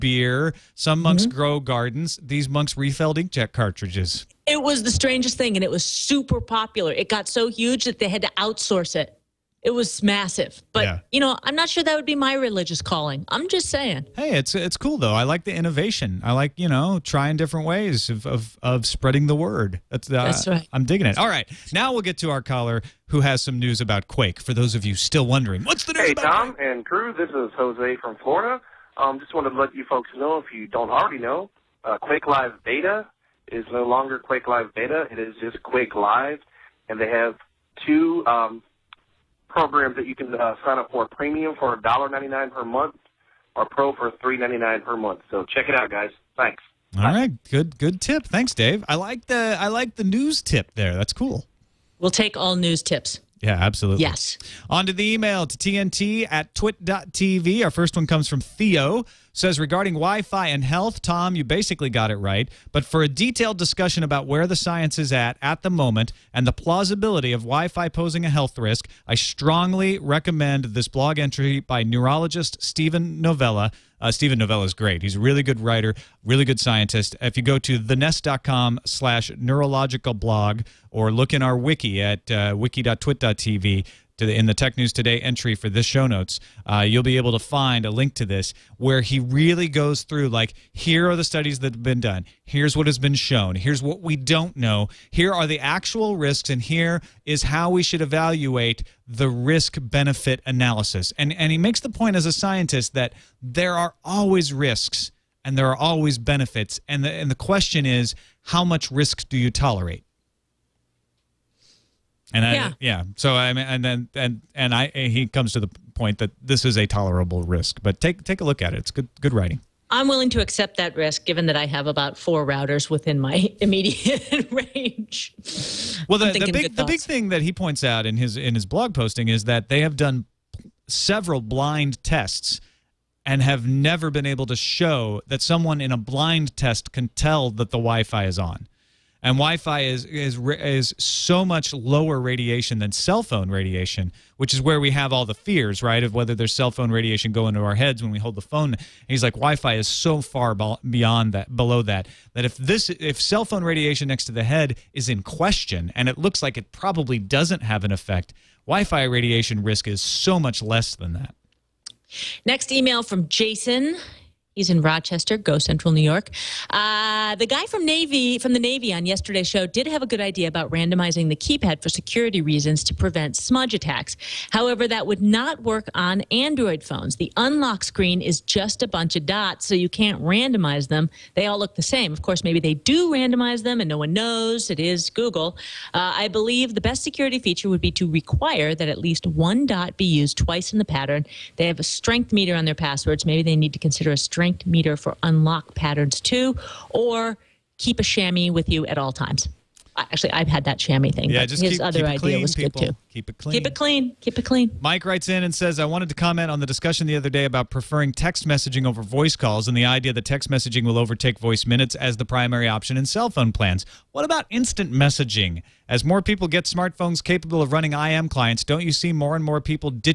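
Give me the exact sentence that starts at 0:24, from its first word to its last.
For those of you still wondering, what's the news Hey Tom and crew, this is Jose from Florida.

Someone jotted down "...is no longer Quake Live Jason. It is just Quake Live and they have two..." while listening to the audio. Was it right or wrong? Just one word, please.
wrong.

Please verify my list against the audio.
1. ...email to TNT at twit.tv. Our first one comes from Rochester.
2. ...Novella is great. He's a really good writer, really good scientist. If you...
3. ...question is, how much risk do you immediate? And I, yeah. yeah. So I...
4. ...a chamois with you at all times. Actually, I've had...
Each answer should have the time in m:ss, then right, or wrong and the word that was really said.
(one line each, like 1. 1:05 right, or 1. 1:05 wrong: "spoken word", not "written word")
1. 0:55 wrong: "Theo", not "Rochester"
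2. 1:14 right
3. 1:47 wrong: "tolerate", not "immediate"
4. 3:17 right.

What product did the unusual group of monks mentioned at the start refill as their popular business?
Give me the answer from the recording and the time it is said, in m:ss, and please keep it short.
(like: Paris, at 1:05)
inkjet cartridges, at 0:03.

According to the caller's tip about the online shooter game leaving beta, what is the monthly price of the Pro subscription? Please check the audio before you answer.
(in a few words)
$3.99.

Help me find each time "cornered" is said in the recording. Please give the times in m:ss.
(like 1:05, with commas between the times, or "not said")
not said.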